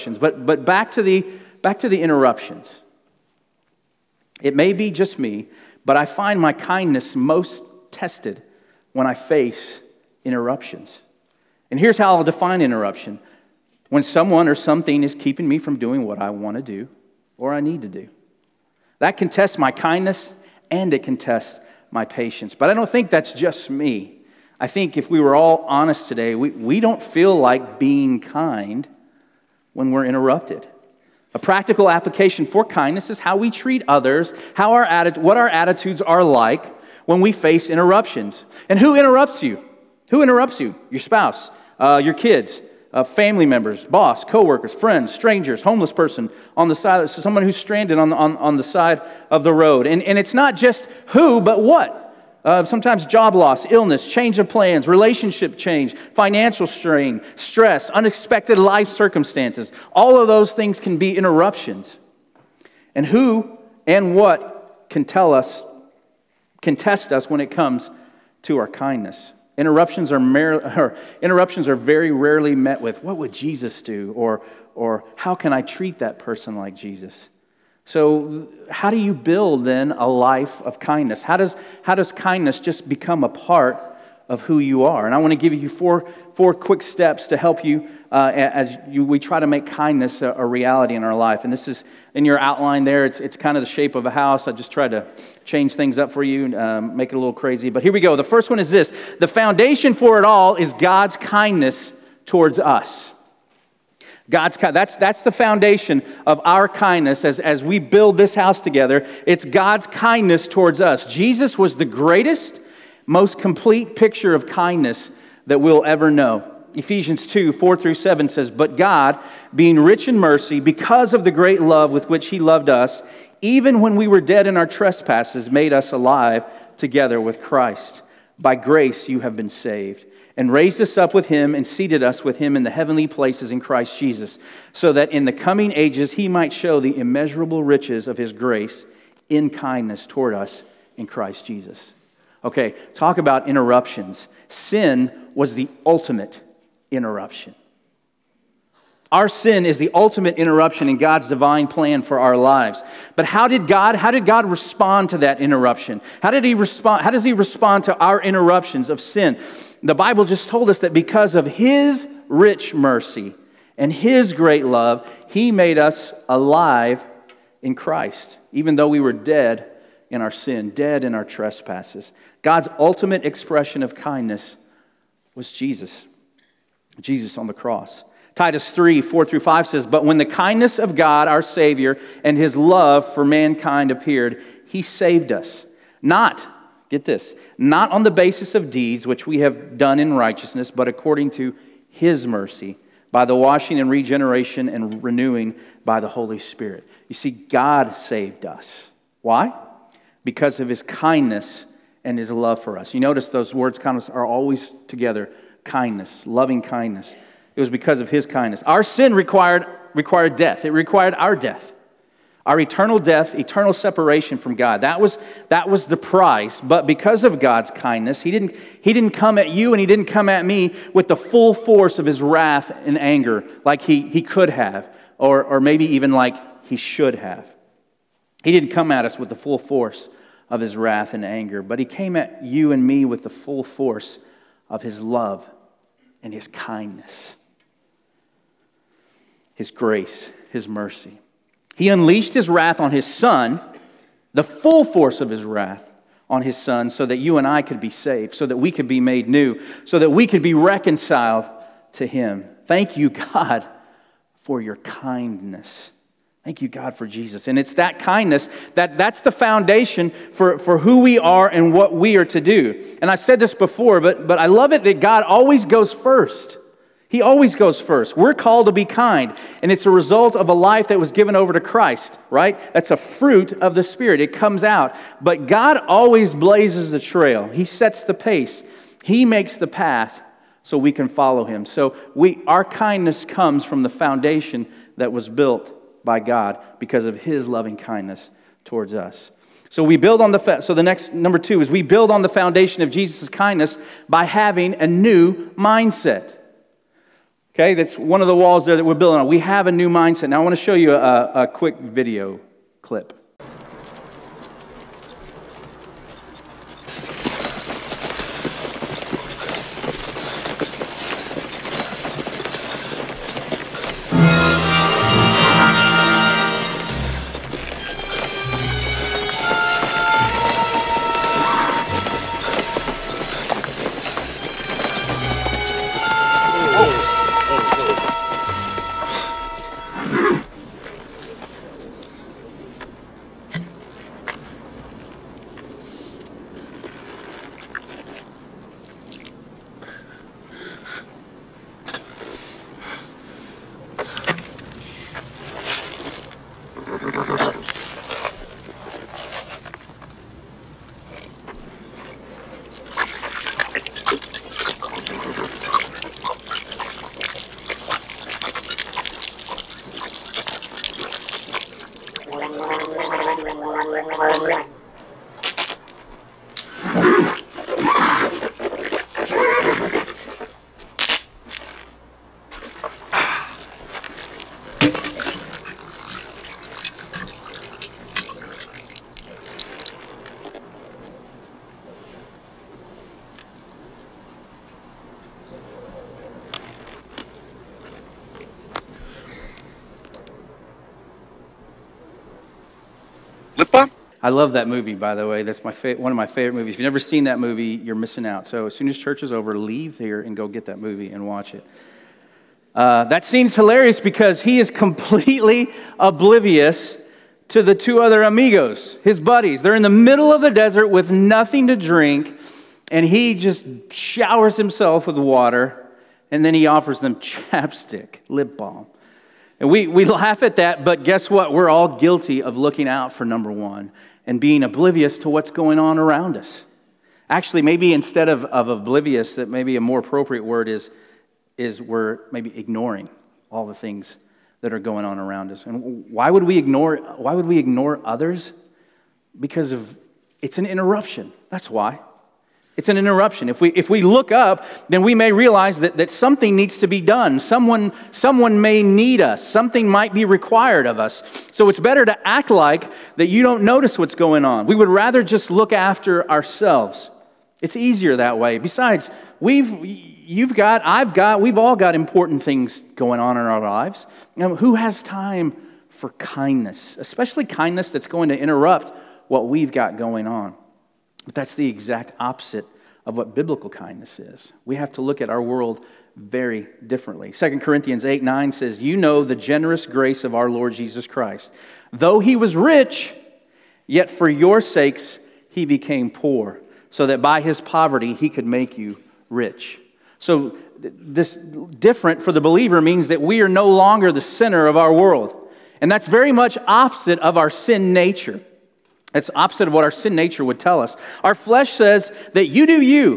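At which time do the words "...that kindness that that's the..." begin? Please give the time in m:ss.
4:17.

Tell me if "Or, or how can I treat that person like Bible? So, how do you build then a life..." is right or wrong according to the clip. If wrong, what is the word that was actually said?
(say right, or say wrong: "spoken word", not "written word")
wrong: "Jesus", not "Bible".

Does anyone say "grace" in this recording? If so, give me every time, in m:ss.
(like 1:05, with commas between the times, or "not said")
2:08, 2:18, 3:59, 7:59.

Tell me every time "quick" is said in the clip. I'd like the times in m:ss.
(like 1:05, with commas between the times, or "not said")
1:26, 5:01.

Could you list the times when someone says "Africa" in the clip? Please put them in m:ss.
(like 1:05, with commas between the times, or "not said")
not said.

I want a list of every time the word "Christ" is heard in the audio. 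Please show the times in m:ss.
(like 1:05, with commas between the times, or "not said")
2:07, 2:13, 2:21, 2:47, 4:31, 8:01.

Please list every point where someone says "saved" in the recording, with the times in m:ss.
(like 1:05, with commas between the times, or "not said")
2:09, 3:04, 3:17, 4:07.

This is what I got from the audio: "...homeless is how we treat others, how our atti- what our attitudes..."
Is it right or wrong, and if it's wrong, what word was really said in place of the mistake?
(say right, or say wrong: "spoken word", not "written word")
wrong: "kindness", not "homeless".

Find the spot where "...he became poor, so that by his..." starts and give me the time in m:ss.
8:05.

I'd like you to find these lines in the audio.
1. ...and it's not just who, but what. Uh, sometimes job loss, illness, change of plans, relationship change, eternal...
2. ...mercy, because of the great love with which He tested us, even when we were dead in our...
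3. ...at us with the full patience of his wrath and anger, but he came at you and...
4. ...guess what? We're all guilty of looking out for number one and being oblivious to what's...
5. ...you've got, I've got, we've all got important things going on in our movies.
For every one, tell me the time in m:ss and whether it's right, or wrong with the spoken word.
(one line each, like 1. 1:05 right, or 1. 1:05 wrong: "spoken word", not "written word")
1. 0:50 wrong: "financial", not "eternal"
2. 2:00 wrong: "loved", not "tested"
3. 3:48 wrong: "force", not "patience"
4. 7:01 right
5. 7:39 wrong: "lives", not "movies".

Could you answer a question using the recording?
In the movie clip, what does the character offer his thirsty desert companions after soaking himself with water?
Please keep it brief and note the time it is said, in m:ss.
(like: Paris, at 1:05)
chapstick, at 6:57.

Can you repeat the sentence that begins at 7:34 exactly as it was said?
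We would rather just look after ourselves.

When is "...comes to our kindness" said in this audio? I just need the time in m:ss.
1:07.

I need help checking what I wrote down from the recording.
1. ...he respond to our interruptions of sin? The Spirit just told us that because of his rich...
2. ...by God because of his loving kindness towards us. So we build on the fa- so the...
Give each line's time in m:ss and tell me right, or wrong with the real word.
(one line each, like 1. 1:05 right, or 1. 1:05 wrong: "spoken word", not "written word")
1. 2:37 wrong: "Bible", not "Spirit"
2. 4:46 right.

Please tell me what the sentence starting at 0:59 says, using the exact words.
All of those things can be interruptions.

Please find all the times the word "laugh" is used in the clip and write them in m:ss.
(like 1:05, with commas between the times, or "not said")
7:00.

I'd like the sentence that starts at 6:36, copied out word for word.
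If you've never seen that movie, you're missing out.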